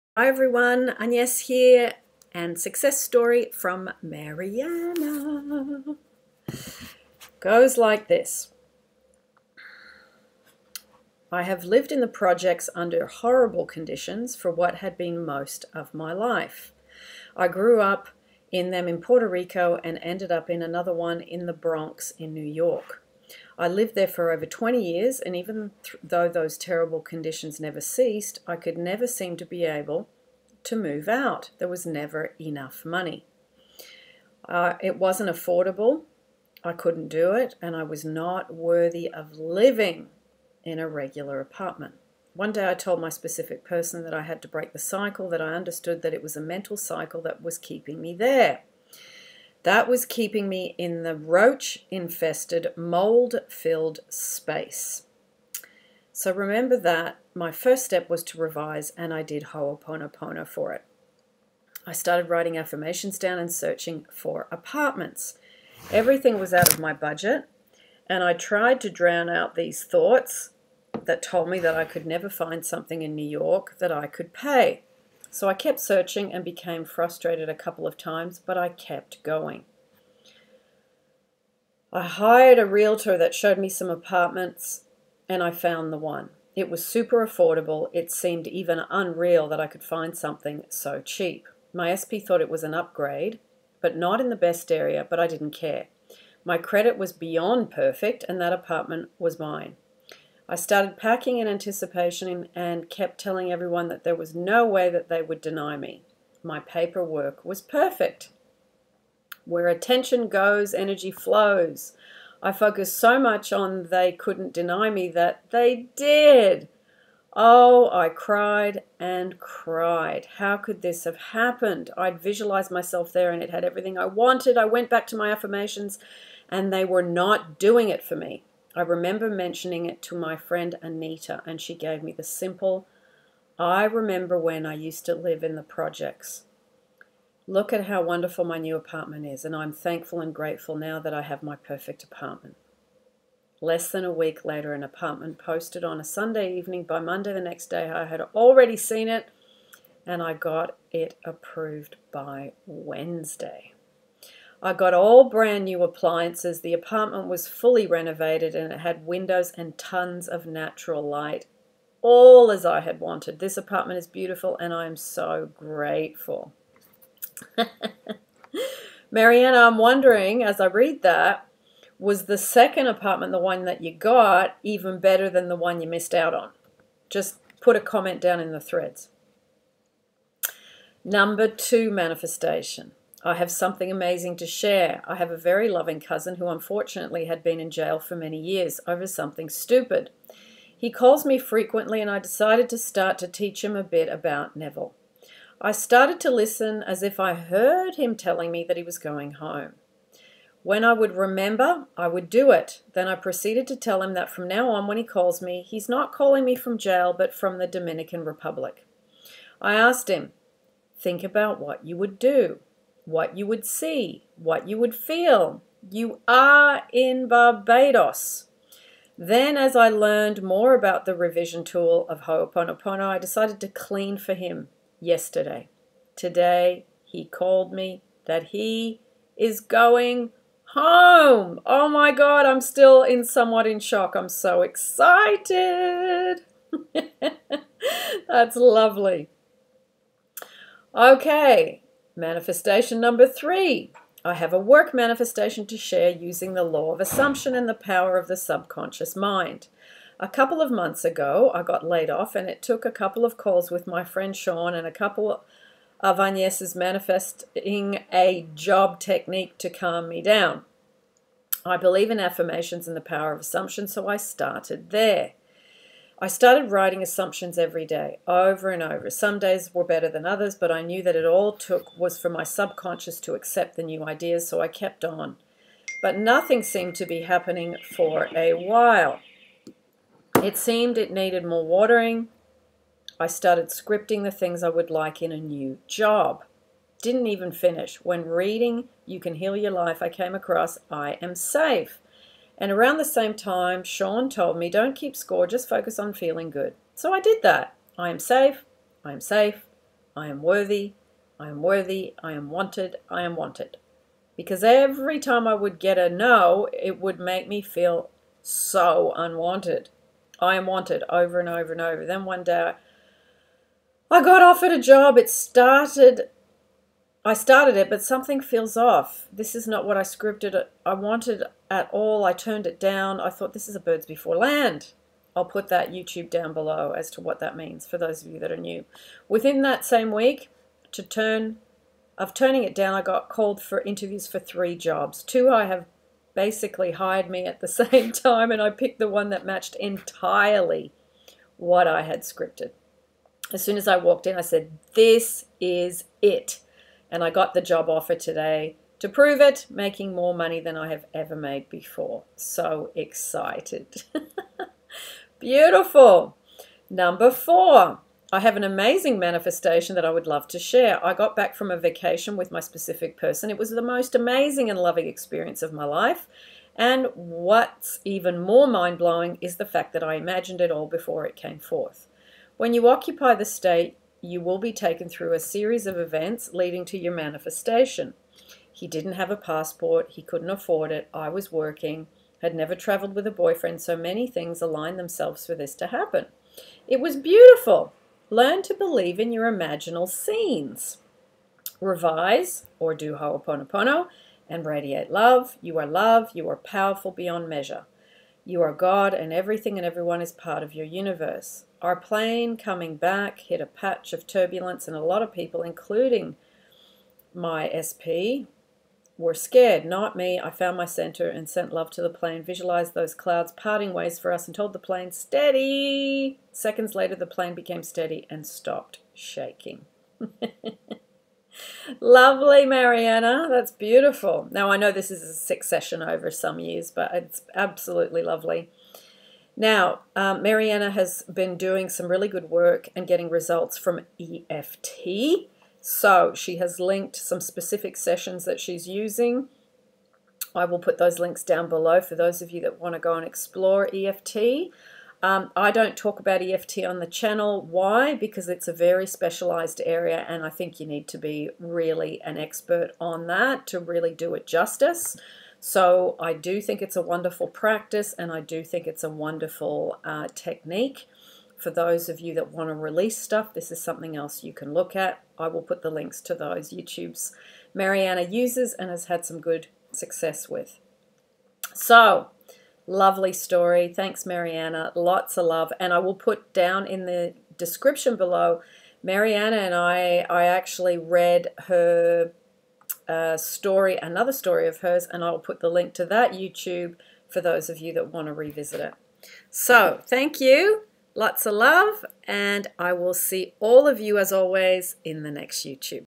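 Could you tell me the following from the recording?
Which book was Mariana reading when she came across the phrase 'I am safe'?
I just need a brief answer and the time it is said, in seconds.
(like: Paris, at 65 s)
You Can Heal Your Life, at 289 s.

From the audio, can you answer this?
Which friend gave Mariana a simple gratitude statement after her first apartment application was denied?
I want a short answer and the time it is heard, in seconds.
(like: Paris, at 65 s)
Anita, at 130 s.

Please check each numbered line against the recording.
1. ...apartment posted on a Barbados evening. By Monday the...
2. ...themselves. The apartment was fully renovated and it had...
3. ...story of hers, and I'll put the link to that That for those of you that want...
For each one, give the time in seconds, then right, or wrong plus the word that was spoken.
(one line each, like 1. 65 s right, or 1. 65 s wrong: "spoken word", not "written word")
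1. 144 s wrong: "Sunday", not "Barbados"
2. 155 s wrong: "appliances", not "themselves"
3. 484 s wrong: "YouTube", not "That".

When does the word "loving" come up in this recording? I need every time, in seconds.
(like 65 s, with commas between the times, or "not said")
185 s, 364 s.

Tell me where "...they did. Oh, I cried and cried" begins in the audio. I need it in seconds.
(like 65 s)
115 s.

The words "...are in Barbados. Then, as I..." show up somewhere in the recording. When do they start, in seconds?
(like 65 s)
216 s.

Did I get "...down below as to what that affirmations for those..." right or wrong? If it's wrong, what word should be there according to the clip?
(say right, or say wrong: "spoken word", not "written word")
wrong: "means", not "affirmations".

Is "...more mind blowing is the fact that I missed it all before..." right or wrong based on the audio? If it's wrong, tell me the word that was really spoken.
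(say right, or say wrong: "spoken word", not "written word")
wrong: "imagined", not "missed".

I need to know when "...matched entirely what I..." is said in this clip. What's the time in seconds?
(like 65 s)
339 s.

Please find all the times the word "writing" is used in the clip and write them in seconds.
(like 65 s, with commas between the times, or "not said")
62 s, 266 s.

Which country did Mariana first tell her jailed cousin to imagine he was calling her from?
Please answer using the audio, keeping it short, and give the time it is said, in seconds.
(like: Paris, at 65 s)
Dominican Republic, at 207 s.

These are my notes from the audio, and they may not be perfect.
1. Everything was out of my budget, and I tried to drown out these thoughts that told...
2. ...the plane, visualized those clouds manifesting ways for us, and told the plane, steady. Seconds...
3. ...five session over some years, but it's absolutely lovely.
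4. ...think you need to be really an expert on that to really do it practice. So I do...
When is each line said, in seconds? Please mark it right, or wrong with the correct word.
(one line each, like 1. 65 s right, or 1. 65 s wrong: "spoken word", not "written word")
1. 65 s right
2. 412 s wrong: "parting", not "manifesting"
3. 425 s wrong: "six", not "five"
4. 450 s wrong: "justice", not "practice".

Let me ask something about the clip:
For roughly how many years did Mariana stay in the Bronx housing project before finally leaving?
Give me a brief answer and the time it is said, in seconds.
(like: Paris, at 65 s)
20, at 24 s.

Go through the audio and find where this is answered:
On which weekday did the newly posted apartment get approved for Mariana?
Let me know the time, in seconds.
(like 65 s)
152 s.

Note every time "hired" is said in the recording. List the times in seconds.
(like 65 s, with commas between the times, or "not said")
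82 s, 336 s.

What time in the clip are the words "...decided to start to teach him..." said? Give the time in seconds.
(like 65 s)
192 s.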